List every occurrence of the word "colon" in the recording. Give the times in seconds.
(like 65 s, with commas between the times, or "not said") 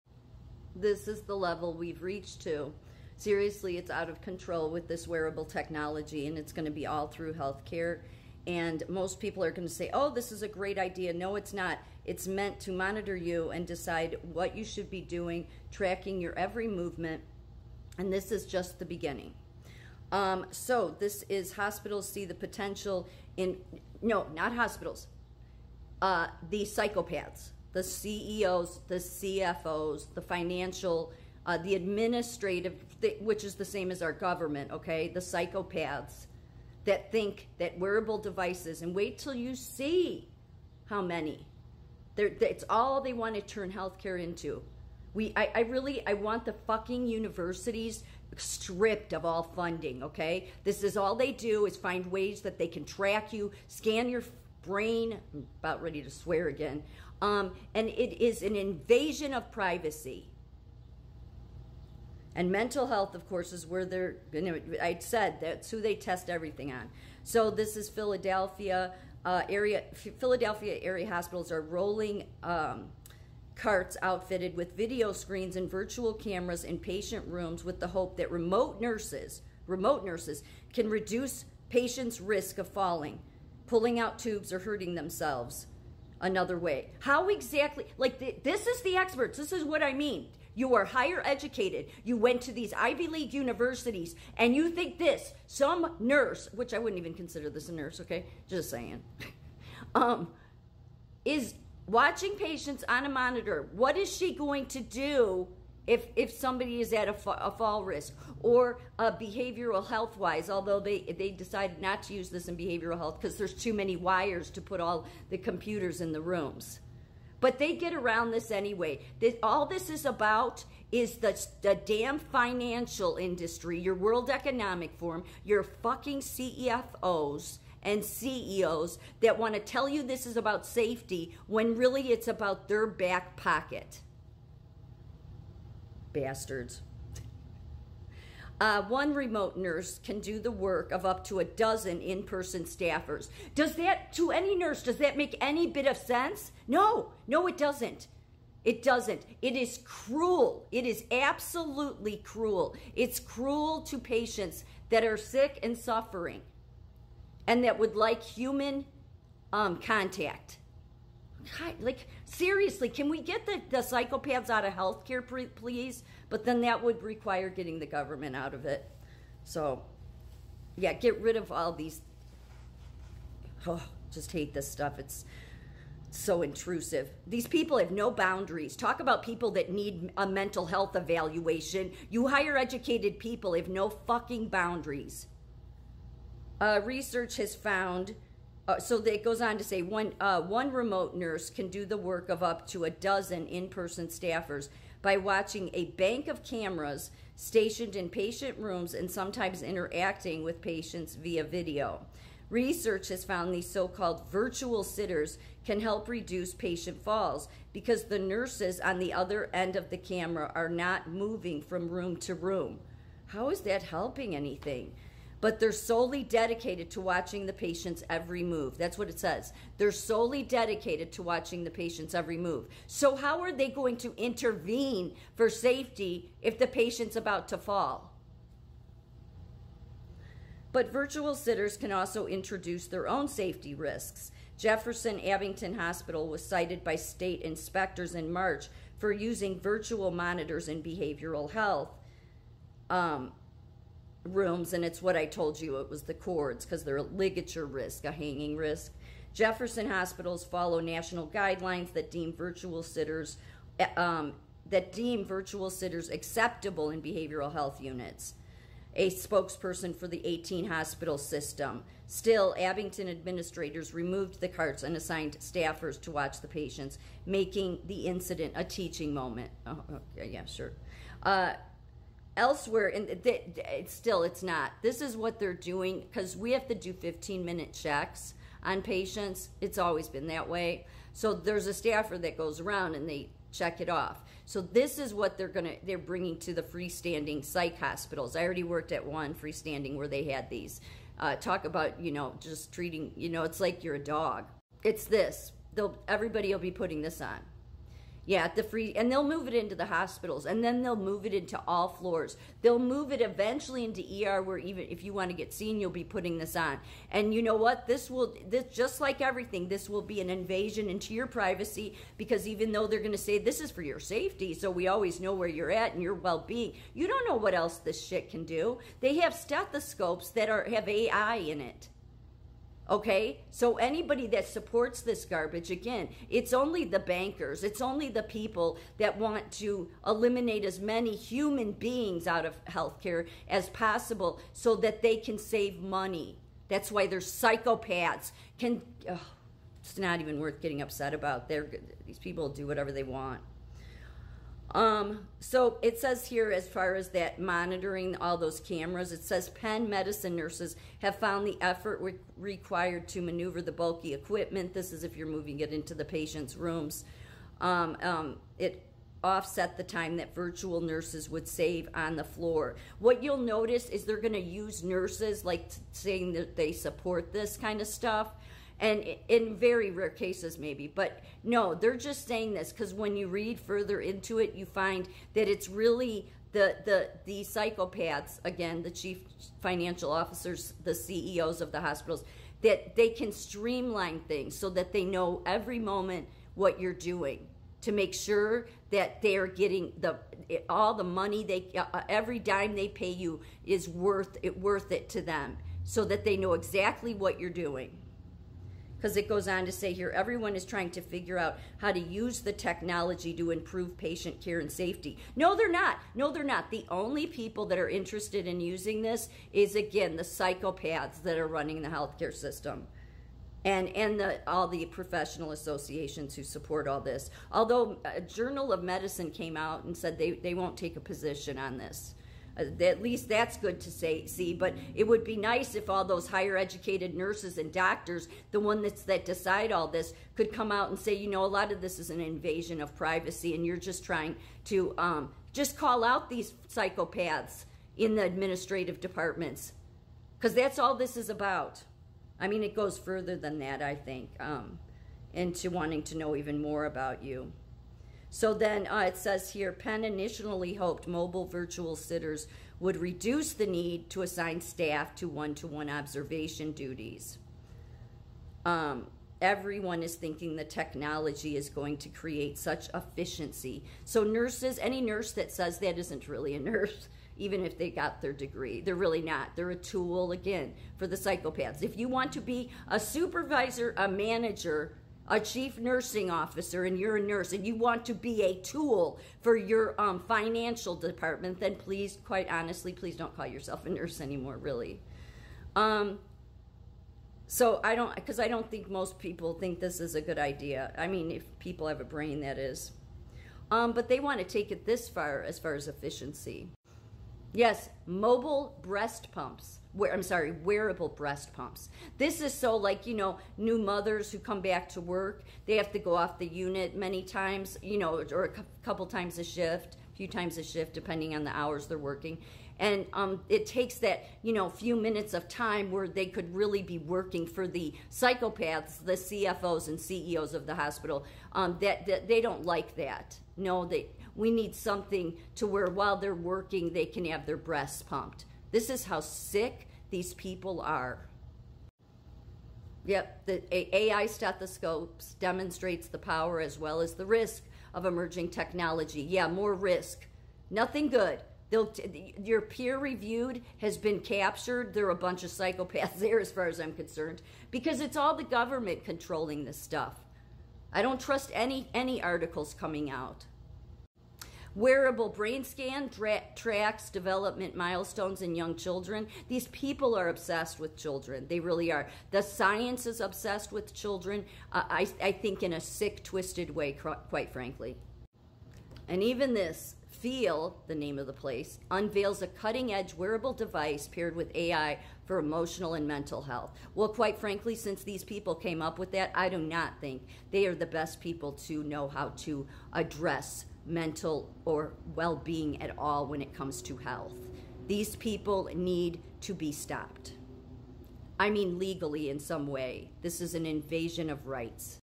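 not said.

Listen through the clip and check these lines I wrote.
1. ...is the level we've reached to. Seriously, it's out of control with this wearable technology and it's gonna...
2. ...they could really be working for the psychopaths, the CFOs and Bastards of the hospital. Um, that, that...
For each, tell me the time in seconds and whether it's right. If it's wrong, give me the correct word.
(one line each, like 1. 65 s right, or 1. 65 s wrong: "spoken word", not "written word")
1. 1 s right
2. 516 s wrong: "CEOs", not "Bastards".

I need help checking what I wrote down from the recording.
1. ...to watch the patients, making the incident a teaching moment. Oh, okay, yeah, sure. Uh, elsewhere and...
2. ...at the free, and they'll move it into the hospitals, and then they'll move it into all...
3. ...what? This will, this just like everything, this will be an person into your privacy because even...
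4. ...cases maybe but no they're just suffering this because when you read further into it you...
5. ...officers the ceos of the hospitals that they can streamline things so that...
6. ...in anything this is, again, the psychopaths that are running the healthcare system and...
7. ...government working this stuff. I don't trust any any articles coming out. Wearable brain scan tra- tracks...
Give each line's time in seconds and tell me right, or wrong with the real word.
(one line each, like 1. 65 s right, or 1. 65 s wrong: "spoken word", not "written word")
1. 266 s right
2. 298 s right
3. 307 s wrong: "invasion", not "person"
4. 370 s wrong: "saying", not "suffering"
5. 380 s right
6. 408 s wrong: "using", not "anything"
7. 548 s wrong: "controlling", not "working".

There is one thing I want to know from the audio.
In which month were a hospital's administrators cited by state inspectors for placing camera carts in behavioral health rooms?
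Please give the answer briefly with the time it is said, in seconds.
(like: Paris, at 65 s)
March, at 238 s.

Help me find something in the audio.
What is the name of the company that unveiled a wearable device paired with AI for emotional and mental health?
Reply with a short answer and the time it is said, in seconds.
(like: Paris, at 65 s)
Feel, at 570 s.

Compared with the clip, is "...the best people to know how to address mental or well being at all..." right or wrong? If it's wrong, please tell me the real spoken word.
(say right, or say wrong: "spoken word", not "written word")
right.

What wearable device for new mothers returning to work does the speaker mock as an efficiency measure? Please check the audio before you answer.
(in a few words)
Wearable breast pumps.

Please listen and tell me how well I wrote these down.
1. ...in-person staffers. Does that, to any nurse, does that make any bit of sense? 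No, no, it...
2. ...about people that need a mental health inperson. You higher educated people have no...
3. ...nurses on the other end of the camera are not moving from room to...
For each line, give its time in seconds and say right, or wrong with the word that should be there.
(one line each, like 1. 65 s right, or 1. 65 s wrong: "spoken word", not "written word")
1. 141 s right
2. 178 s wrong: "evaluation", not "inperson"
3. 208 s right.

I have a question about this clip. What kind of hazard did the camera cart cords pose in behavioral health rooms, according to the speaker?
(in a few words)
Ligature risk.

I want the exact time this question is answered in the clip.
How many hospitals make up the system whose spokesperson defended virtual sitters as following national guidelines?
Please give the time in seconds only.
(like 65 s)
260 s.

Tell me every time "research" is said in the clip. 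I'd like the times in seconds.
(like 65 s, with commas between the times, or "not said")
186 s, 202 s.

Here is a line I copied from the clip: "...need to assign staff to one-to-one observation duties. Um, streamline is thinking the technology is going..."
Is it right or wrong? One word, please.
wrong.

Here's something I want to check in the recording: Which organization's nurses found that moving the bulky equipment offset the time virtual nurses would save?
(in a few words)
Penn Medicine.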